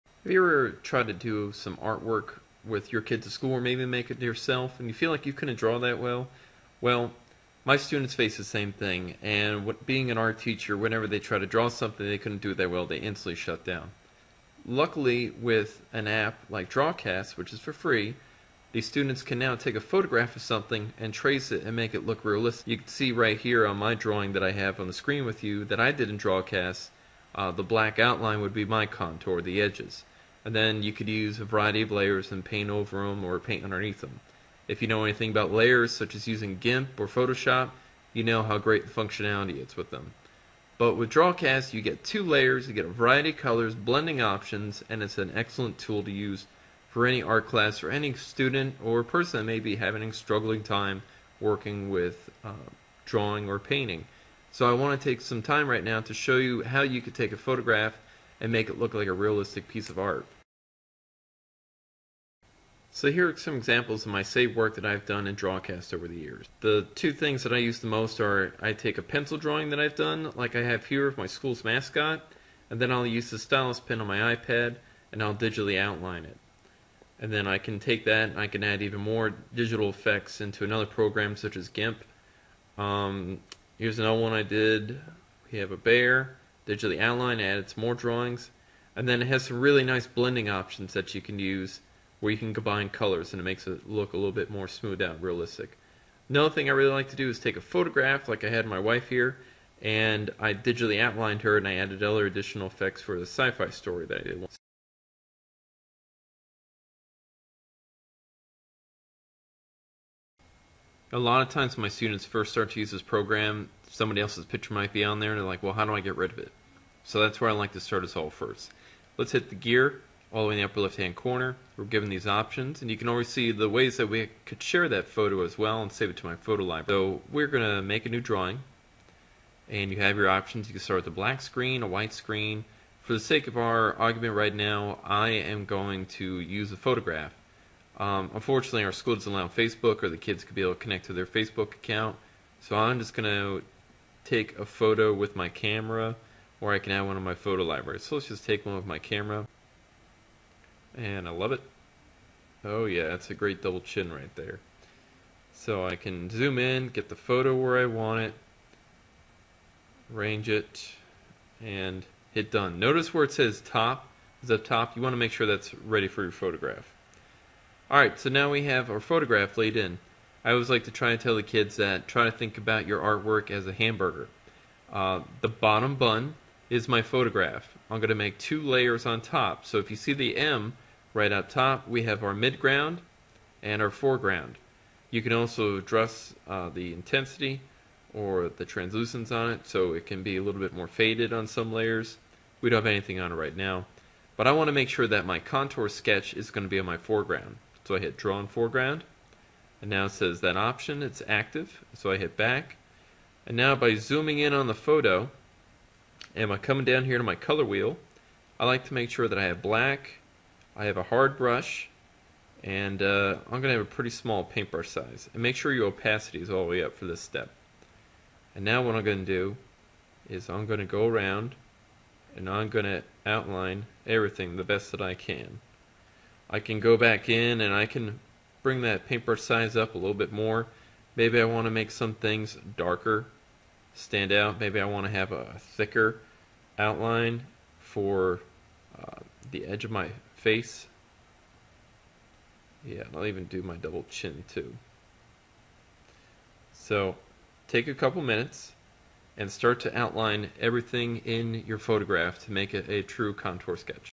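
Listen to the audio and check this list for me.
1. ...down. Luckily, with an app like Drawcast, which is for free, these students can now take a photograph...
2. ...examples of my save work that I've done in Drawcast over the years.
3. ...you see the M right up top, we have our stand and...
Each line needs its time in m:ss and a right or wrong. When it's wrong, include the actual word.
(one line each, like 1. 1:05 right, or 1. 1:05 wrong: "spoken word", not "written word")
1. 0:13 right
2. 1:03 right
3. 2:59 wrong: "midground", not "stand".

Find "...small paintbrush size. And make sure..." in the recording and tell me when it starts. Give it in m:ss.
3:34.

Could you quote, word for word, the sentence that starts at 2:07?
So we're going to make a new drawing and you have your options.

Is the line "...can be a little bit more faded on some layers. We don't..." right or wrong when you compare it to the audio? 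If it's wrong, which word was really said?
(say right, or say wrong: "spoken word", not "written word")
right.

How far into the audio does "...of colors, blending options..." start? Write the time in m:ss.
0:43.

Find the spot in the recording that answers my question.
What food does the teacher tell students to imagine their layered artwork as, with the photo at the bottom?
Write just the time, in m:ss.
2:53.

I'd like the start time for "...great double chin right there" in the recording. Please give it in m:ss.
2:33.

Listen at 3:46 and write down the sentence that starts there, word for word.
I can go back in and I can bring that paintbrush size up a little bit more.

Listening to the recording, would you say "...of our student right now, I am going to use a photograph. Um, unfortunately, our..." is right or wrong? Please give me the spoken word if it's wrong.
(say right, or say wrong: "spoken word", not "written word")
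wrong: "argument", not "student".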